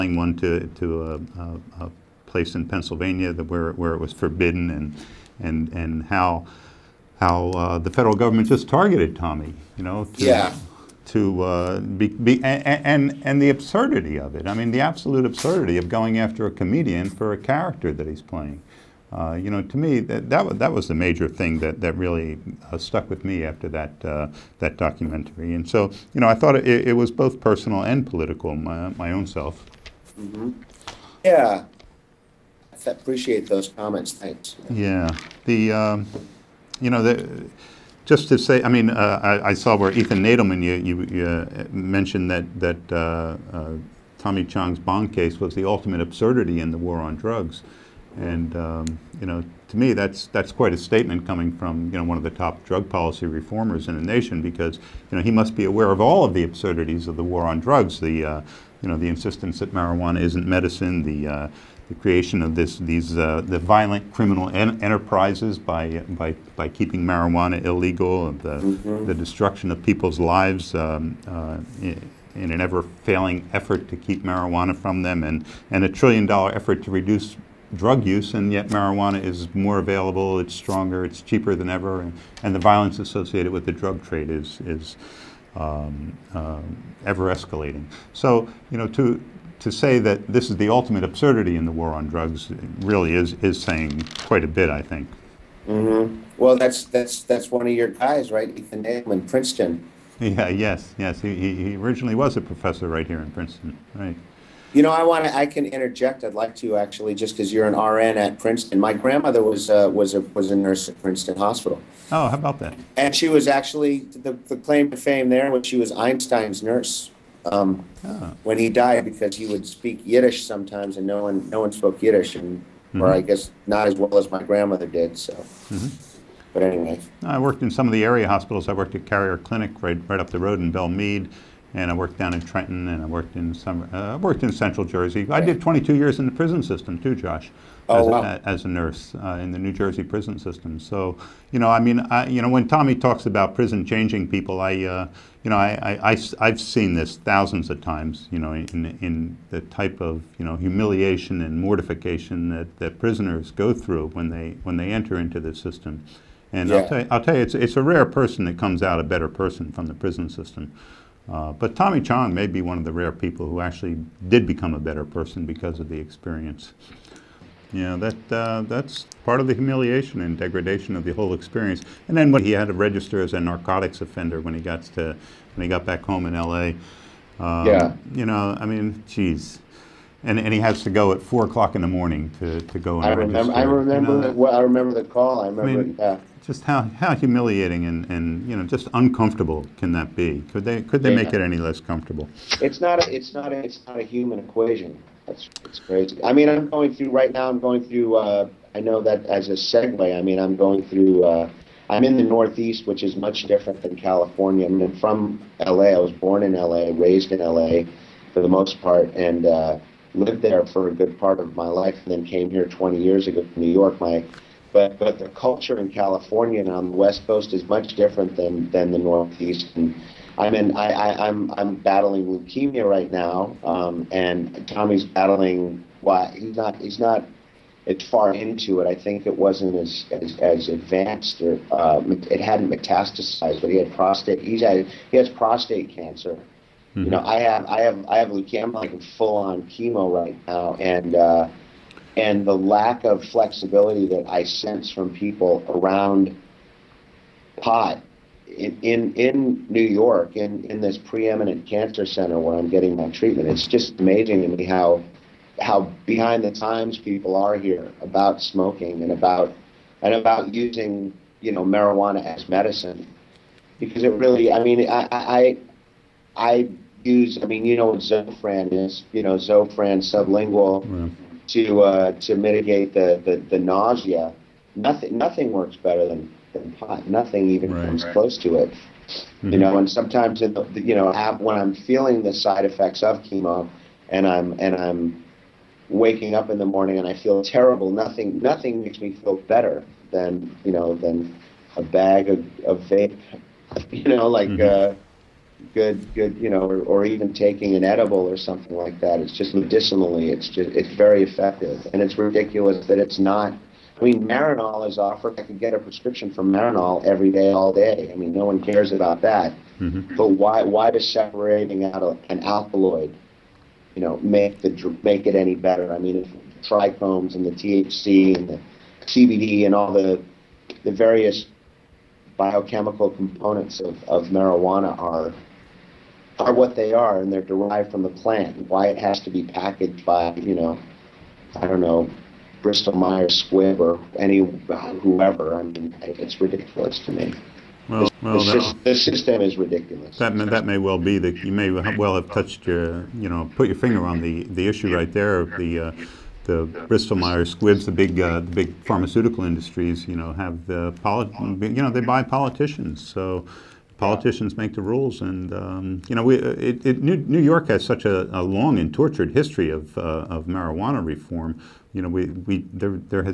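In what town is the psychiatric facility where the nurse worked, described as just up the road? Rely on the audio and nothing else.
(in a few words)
Belle Mead.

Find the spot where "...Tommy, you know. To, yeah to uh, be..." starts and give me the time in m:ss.
0:09.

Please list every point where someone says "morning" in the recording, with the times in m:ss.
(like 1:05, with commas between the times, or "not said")
3:01, 4:46.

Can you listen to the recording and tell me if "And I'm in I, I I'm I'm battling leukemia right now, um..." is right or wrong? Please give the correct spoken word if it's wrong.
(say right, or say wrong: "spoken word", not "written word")
right.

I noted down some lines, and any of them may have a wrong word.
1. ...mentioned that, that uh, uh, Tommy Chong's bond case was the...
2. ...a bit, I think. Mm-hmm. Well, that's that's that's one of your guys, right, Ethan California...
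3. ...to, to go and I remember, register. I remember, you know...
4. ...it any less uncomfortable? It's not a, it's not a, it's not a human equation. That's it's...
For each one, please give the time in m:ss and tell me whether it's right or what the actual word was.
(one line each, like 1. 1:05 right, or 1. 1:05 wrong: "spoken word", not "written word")
1. 0:41 right
2. 1:34 wrong: "Allen", not "California"
3. 3:02 right
4. 3:11 wrong: "comfortable", not "uncomfortable".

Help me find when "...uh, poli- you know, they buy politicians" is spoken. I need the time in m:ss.
5:50.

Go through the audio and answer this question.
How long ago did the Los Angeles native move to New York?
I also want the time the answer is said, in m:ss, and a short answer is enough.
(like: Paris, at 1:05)
20 years, at 3:32.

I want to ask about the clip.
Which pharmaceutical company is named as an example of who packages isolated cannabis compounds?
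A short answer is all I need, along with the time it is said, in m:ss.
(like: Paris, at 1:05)
Bristol Myers Squibb, at 5:32.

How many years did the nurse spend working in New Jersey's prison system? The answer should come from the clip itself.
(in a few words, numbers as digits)
22.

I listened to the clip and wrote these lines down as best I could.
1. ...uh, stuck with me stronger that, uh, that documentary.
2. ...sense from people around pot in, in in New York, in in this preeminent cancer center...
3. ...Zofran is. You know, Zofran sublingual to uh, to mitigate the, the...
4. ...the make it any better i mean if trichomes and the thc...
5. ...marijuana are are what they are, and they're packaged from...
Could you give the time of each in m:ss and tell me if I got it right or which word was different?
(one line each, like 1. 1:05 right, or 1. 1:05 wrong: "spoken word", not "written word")
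1. 0:22 wrong: "after", not "stronger"
2. 4:04 right
3. 4:27 right
4. 5:14 right
5. 5:24 wrong: "derived", not "packaged".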